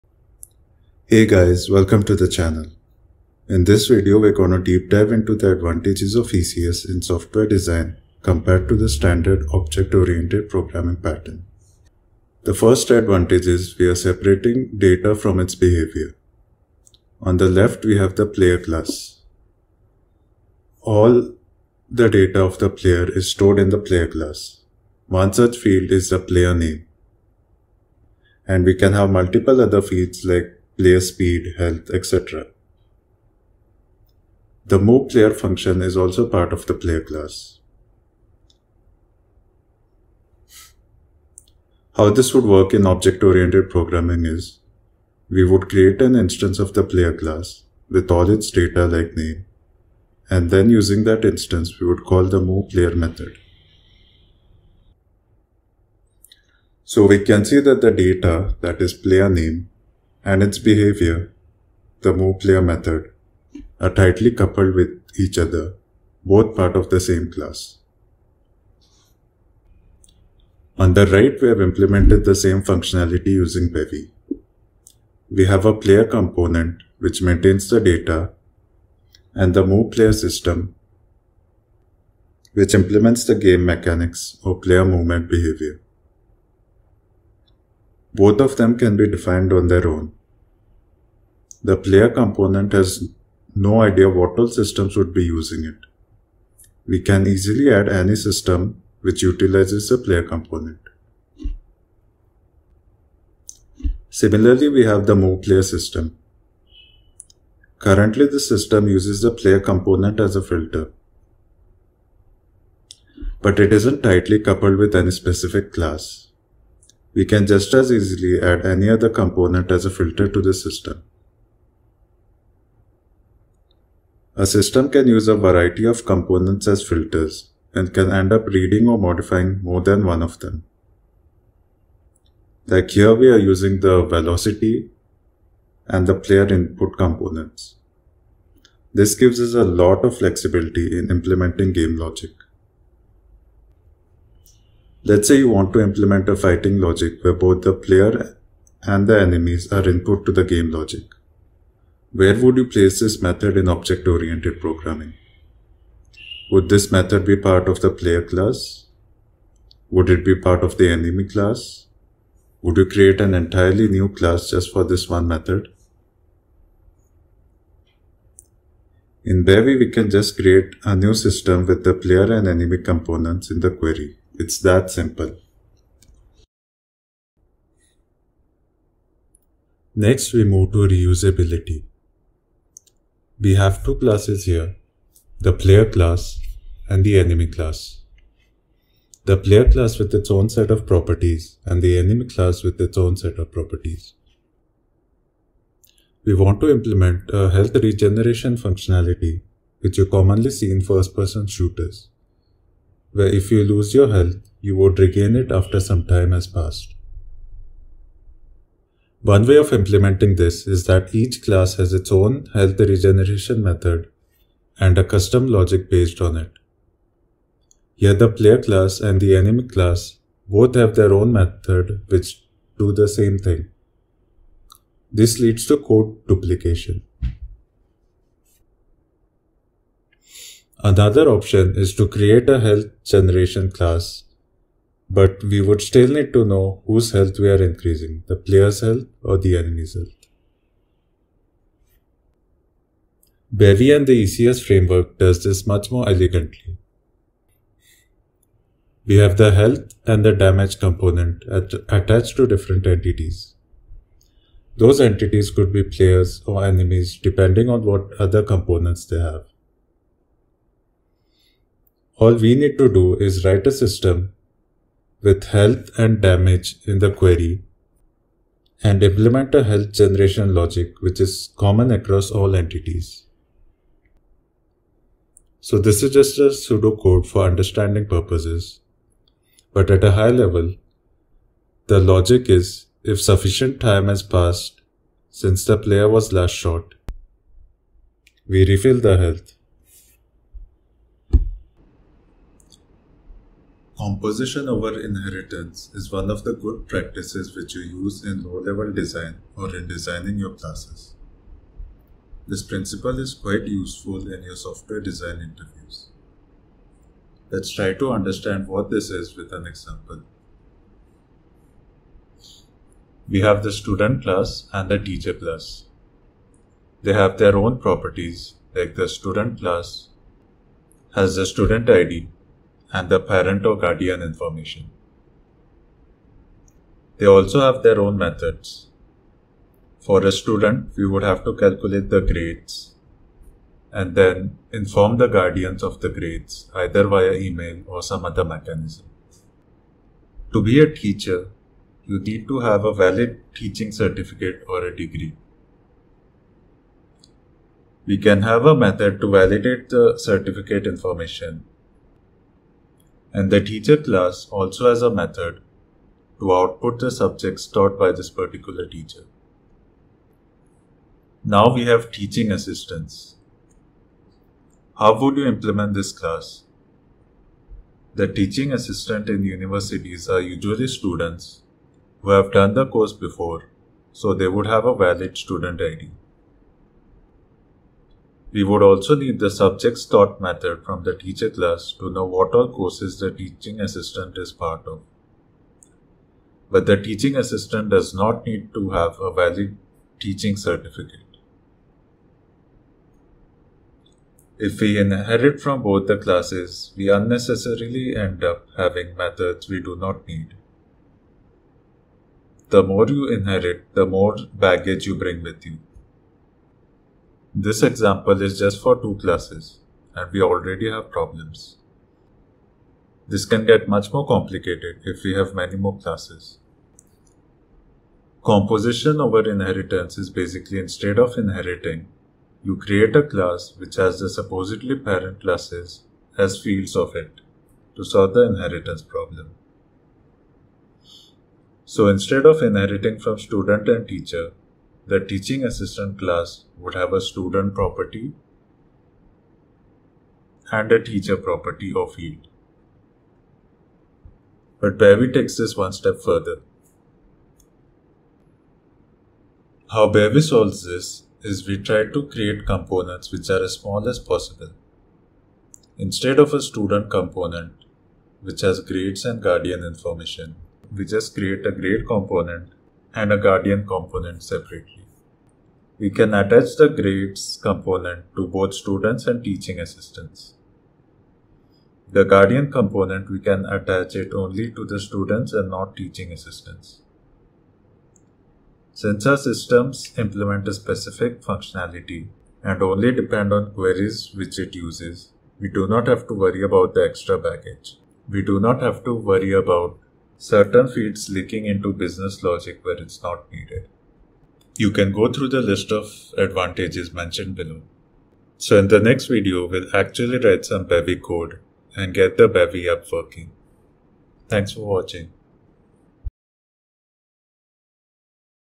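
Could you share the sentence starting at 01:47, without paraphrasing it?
Currently, the system uses the player component as a filter.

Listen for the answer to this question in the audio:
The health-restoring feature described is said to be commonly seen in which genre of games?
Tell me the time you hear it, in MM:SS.
03:20.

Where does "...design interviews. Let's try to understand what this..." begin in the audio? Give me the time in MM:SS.
05:05.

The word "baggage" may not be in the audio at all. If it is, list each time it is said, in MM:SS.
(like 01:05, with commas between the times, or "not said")
06:44, 08:07.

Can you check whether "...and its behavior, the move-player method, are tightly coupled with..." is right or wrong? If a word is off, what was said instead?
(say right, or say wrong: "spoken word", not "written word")
right.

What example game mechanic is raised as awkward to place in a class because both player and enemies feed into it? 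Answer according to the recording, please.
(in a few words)
fighting logic.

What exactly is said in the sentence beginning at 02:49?
In Bevy, we can just create a new system with the player and enemy components in the query.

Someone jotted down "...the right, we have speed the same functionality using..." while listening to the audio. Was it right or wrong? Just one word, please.
wrong.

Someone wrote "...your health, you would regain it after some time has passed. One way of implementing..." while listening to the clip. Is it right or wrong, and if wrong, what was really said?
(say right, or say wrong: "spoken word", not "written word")
right.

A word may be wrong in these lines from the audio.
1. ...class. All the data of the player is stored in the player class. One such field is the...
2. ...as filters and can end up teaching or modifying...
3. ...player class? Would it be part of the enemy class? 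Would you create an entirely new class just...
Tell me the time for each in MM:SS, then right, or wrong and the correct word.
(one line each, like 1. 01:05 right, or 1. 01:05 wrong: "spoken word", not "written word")
1. 00:18 right
2. 02:06 wrong: "reading", not "teaching"
3. 02:37 right.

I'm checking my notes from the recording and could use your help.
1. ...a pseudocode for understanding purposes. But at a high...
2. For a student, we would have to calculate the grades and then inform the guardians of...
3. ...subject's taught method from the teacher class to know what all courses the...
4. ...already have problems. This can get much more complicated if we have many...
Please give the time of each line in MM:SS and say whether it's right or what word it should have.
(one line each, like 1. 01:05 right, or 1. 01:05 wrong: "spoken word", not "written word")
1. 04:36 right
2. 05:29 right
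3. 06:19 right
4. 06:50 right.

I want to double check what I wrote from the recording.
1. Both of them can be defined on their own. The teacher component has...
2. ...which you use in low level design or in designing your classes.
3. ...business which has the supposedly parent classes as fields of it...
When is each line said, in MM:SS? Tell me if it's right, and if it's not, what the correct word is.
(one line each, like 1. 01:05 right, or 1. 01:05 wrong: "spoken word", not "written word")
1. 01:28 wrong: "player", not "teacher"
2. 04:57 right
3. 07:03 wrong: "class", not "business".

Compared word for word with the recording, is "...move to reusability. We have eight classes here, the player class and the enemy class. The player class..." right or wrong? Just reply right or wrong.
wrong.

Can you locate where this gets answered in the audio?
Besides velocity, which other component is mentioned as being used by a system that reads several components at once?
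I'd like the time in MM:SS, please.
02:16.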